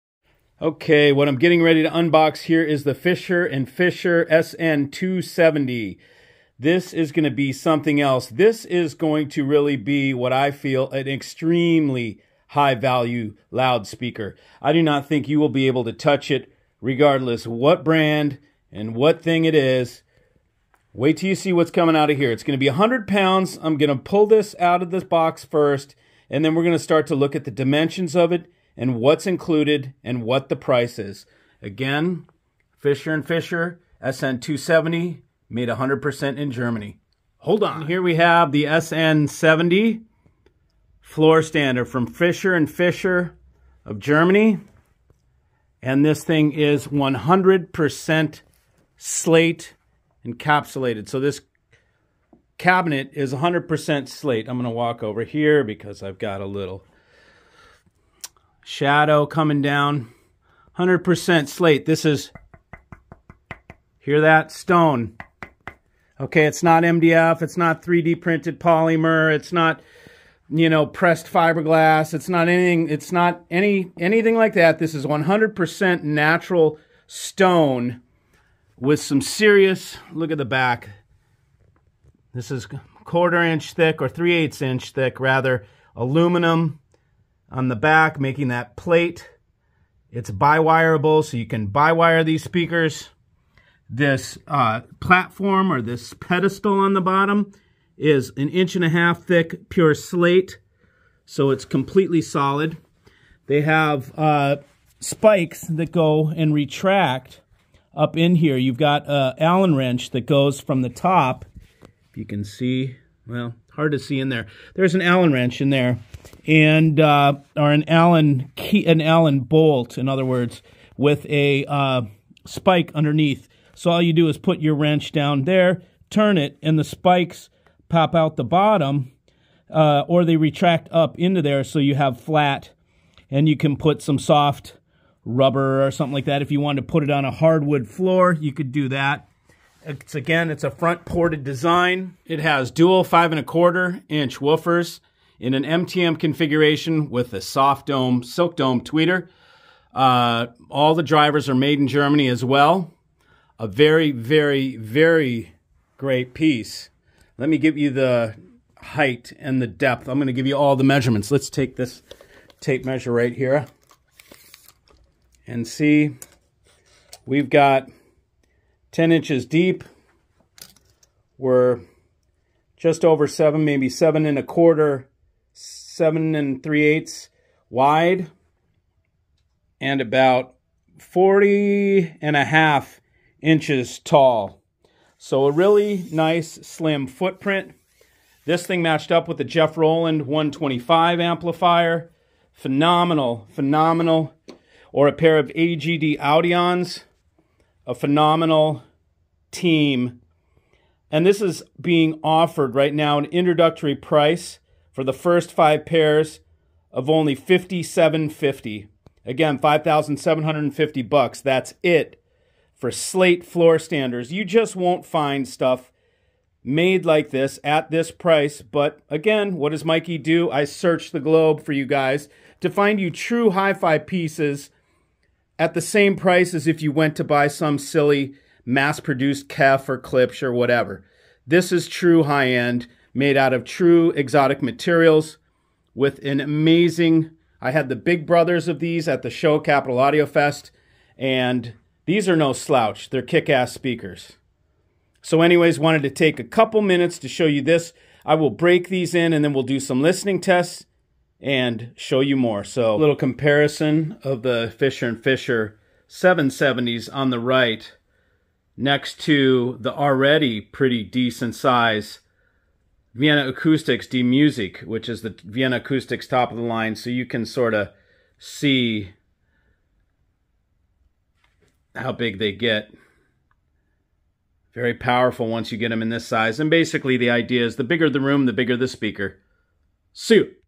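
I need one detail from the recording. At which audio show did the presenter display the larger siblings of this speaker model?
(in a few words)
Capital Audio Fest.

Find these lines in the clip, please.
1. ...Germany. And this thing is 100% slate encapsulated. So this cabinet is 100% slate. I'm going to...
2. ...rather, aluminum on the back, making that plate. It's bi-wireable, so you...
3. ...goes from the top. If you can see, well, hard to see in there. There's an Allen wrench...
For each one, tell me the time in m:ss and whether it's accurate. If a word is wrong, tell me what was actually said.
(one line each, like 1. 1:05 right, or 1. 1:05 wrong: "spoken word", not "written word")
1. 0:43 right
2. 1:25 right
3. 1:50 right.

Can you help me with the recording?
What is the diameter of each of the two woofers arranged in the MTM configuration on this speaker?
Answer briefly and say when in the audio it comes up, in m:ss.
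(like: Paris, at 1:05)
5 1/4 inch, at 2:23.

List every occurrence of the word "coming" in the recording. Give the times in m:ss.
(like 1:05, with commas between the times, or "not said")
0:21, 0:59.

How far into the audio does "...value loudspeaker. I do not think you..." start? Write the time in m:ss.
0:12.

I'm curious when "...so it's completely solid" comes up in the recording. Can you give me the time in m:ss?
1:41.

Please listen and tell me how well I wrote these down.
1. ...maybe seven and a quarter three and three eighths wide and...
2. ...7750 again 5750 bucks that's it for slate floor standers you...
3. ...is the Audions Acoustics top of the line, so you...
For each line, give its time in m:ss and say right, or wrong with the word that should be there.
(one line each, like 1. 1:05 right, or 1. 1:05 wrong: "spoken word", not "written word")
1. 2:53 wrong: "seven", not "three"
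2. 3:27 wrong: "5750", not "7750"
3. 4:25 wrong: "Vienna", not "Audions".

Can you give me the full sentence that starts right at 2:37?
Let me give you the height and the depth.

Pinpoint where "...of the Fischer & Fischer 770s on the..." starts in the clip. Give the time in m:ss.
4:14.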